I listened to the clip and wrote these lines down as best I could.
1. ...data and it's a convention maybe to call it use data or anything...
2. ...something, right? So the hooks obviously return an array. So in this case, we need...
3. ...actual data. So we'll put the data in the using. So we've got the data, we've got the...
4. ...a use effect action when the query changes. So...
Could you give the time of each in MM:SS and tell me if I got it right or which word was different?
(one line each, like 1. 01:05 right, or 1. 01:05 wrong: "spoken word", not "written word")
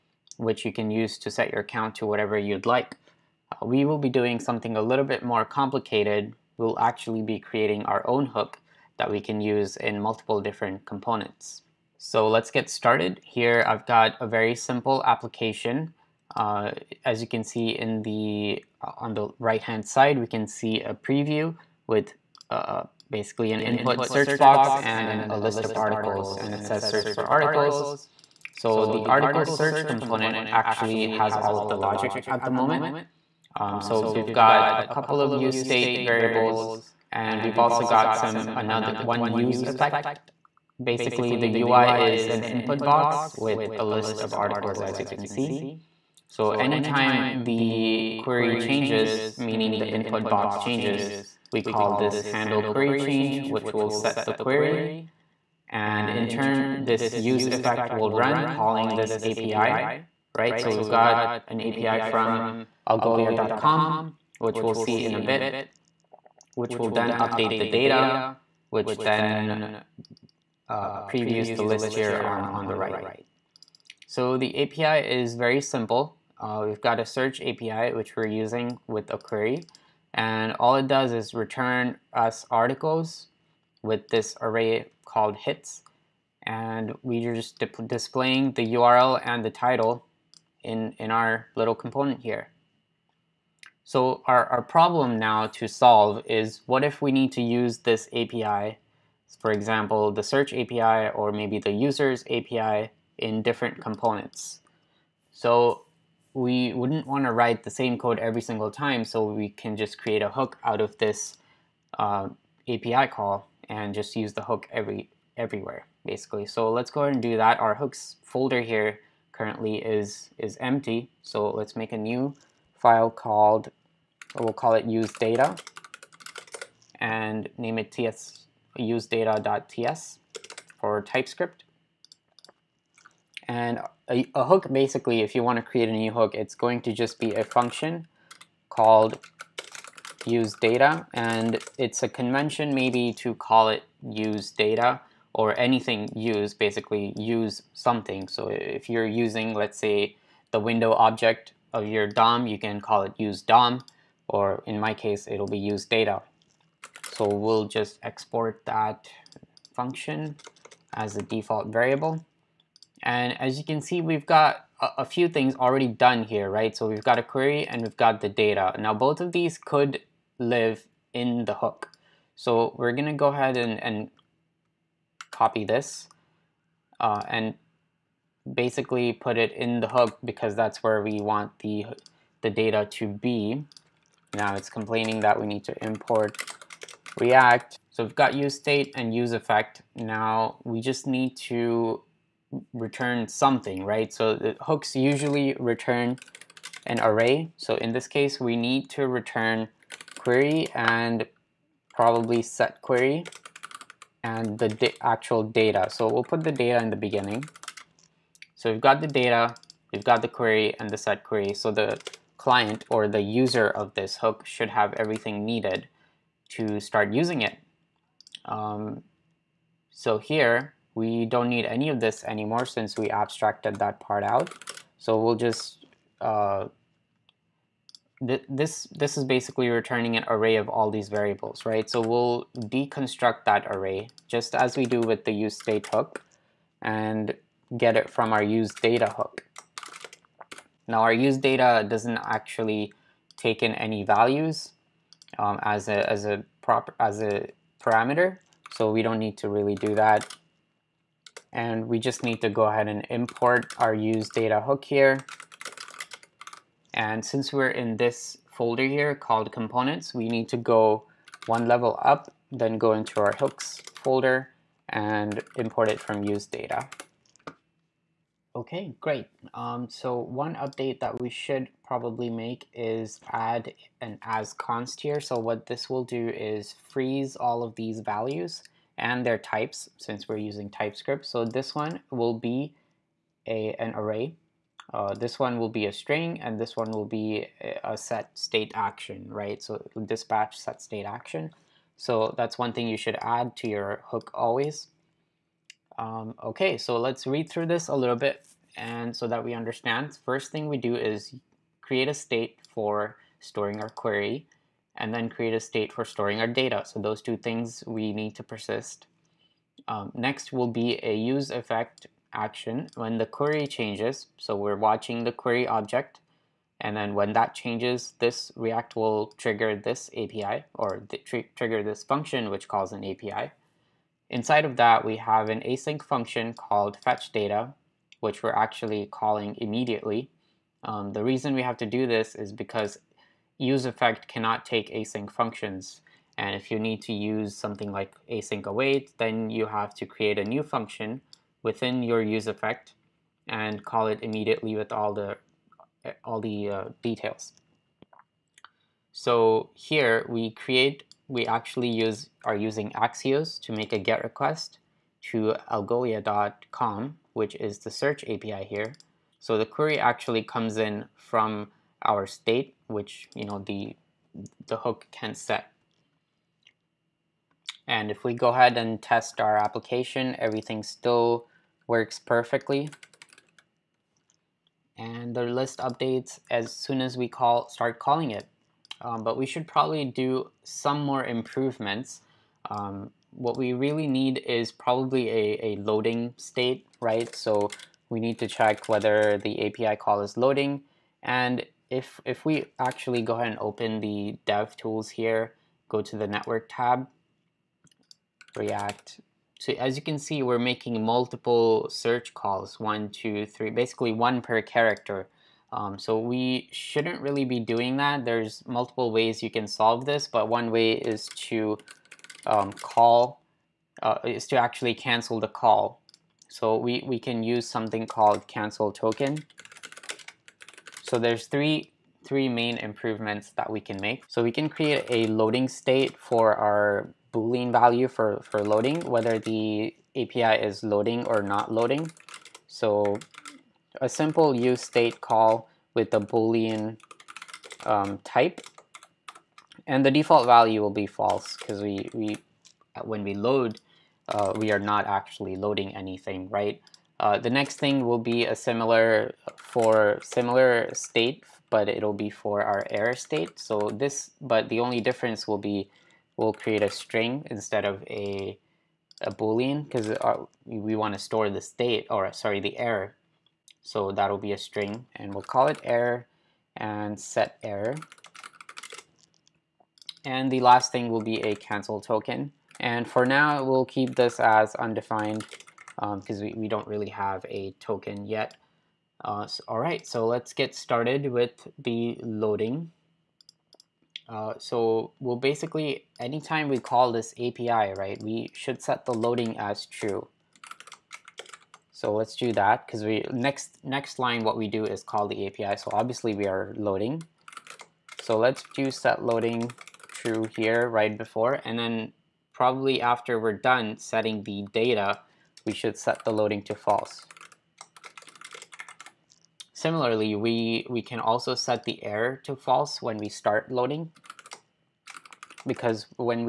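1. 02:20 right
2. 03:13 wrong: "usually", not "obviously"
3. 03:25 wrong: "beginning", not "using"
4. 05:11 right.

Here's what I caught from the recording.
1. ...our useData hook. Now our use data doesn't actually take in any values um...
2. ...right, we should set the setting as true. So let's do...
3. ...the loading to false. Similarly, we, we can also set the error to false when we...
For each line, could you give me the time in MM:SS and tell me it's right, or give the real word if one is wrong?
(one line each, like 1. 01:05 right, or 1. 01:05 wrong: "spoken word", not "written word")
1. 03:58 right
2. 08:07 wrong: "loading", not "setting"
3. 08:26 right.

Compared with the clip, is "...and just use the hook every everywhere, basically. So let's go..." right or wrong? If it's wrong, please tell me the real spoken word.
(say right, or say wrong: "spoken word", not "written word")
right.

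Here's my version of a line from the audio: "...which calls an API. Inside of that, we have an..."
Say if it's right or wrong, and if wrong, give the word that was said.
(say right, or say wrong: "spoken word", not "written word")
right.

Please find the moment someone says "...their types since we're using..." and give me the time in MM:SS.
04:39.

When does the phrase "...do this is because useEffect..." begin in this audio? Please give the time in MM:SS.
05:31.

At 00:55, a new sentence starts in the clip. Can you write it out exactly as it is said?
And in turn, this use effect will run calling this API, right?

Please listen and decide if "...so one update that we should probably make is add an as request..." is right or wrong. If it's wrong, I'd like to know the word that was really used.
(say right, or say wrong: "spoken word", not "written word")
wrong: "const", not "request".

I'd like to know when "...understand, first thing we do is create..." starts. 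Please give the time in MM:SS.
04:59.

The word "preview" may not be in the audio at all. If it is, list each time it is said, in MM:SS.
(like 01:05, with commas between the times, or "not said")
00:20, 01:11.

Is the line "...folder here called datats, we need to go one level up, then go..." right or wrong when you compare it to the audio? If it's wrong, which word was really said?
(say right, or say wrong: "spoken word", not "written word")
wrong: "components", not "datats".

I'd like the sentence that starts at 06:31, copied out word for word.
And if, if we actually go ahead and open the dev tools here, go to the network tab, React.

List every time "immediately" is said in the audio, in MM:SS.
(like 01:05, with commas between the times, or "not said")
05:29, 05:44.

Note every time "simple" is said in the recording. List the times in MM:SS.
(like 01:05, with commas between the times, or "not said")
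00:14, 01:15, 07:14.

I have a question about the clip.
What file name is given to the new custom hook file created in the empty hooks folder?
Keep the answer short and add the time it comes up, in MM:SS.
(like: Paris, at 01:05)
use data.ts, at 02:08.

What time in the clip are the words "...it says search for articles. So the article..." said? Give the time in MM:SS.
00:26.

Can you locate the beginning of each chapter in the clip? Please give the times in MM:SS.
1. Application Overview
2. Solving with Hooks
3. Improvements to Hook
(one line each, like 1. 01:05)
1. 00:12
2. 01:46
3. 06:19.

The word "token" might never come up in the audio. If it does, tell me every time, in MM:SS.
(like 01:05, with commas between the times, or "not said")
06:58, 07:52, 07:57.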